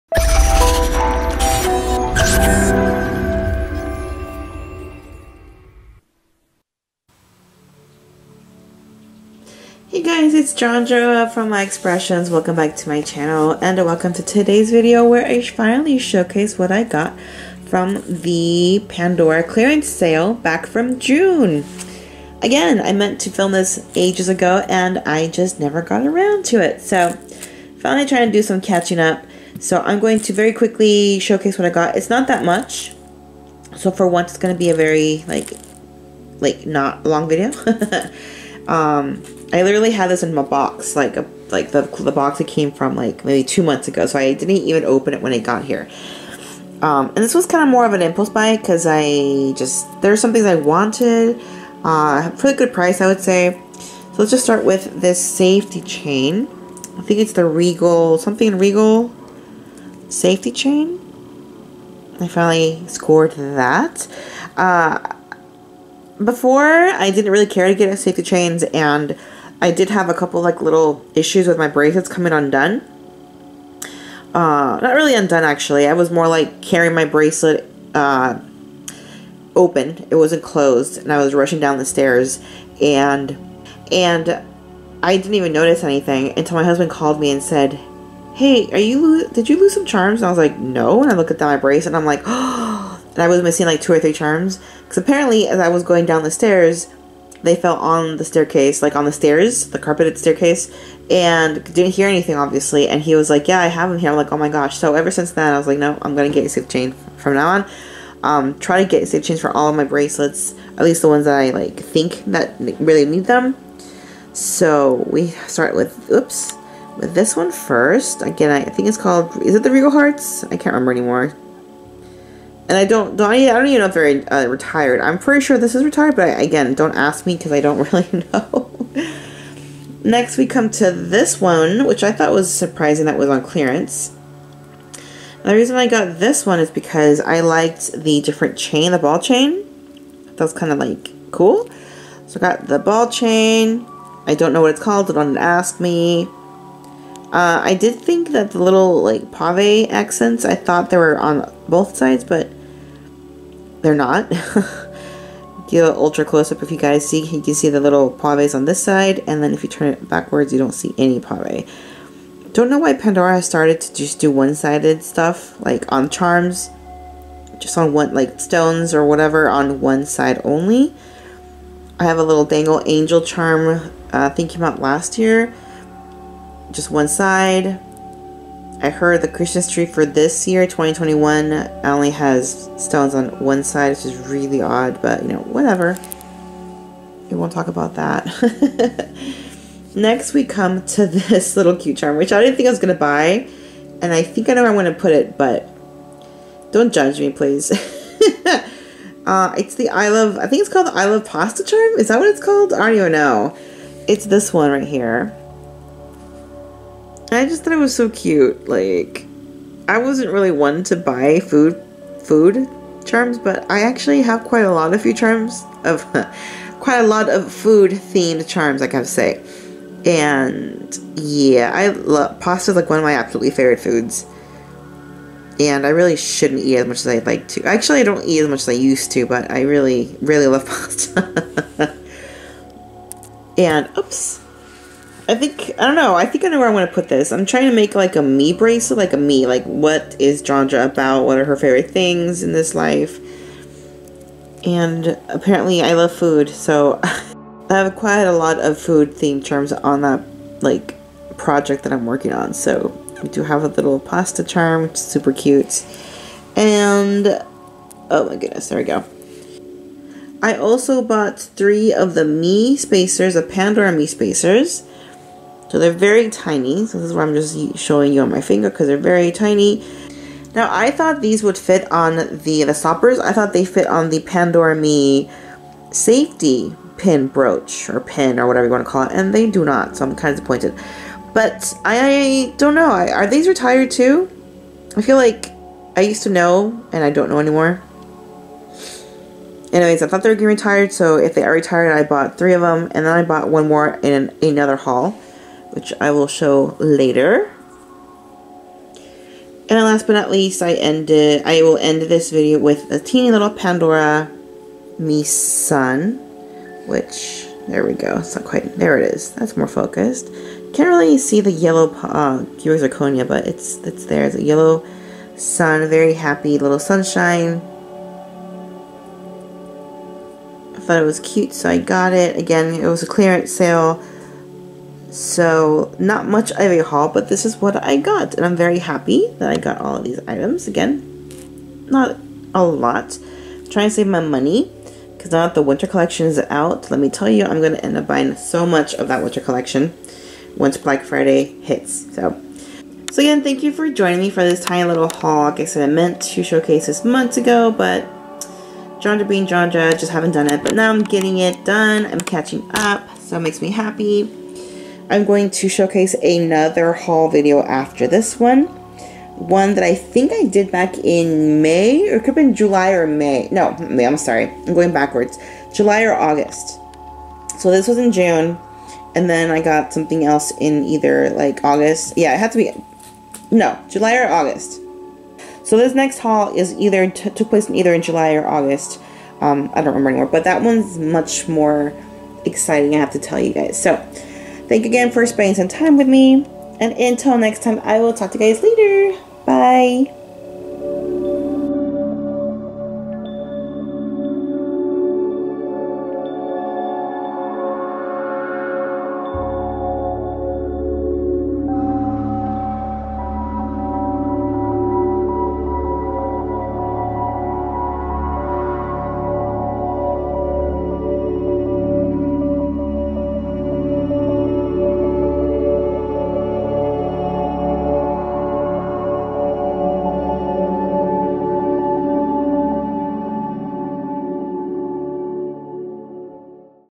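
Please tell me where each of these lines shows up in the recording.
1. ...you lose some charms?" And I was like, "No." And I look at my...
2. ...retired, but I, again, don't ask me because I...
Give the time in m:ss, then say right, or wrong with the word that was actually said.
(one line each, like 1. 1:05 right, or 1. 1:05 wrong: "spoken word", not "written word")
1. 1:29 right
2. 2:05 right.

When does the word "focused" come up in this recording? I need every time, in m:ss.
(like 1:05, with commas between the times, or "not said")
5:09.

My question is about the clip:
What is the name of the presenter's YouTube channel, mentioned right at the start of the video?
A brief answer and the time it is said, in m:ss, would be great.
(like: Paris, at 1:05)
My Xpressions, at 0:11.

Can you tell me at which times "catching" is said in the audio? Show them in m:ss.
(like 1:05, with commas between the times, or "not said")
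0:28, 5:52.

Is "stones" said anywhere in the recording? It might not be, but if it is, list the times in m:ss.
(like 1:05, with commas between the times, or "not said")
2:48, 3:02.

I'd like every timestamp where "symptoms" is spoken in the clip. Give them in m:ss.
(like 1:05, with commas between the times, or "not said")
not said.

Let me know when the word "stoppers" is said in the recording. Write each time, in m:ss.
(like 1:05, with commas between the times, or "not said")
4:32.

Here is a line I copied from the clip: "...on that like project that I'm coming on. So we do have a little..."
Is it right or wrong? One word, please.
wrong.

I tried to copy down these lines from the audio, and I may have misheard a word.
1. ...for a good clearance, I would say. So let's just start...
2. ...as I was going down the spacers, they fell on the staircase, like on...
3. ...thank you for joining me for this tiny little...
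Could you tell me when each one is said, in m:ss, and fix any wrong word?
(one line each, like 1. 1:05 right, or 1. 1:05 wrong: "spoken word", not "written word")
1. 0:52 wrong: "price", not "clearance"
2. 1:35 wrong: "stairs", not "spacers"
3. 5:43 right.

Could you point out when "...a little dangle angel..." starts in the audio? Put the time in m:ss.
2:52.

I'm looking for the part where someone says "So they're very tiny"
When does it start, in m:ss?
4:25.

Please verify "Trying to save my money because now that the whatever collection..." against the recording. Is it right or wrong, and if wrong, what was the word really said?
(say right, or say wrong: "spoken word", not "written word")
wrong: "winter", not "whatever".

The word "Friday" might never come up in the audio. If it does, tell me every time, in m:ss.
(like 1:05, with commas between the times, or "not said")
5:41.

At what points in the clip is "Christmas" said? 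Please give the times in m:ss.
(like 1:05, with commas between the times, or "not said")
2:59.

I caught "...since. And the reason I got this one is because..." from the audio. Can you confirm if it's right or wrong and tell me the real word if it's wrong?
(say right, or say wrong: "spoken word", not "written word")
wrong: "clearance", not "since".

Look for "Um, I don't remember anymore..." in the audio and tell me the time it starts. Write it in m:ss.
6:19.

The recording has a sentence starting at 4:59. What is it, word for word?
And last but not least, I ended.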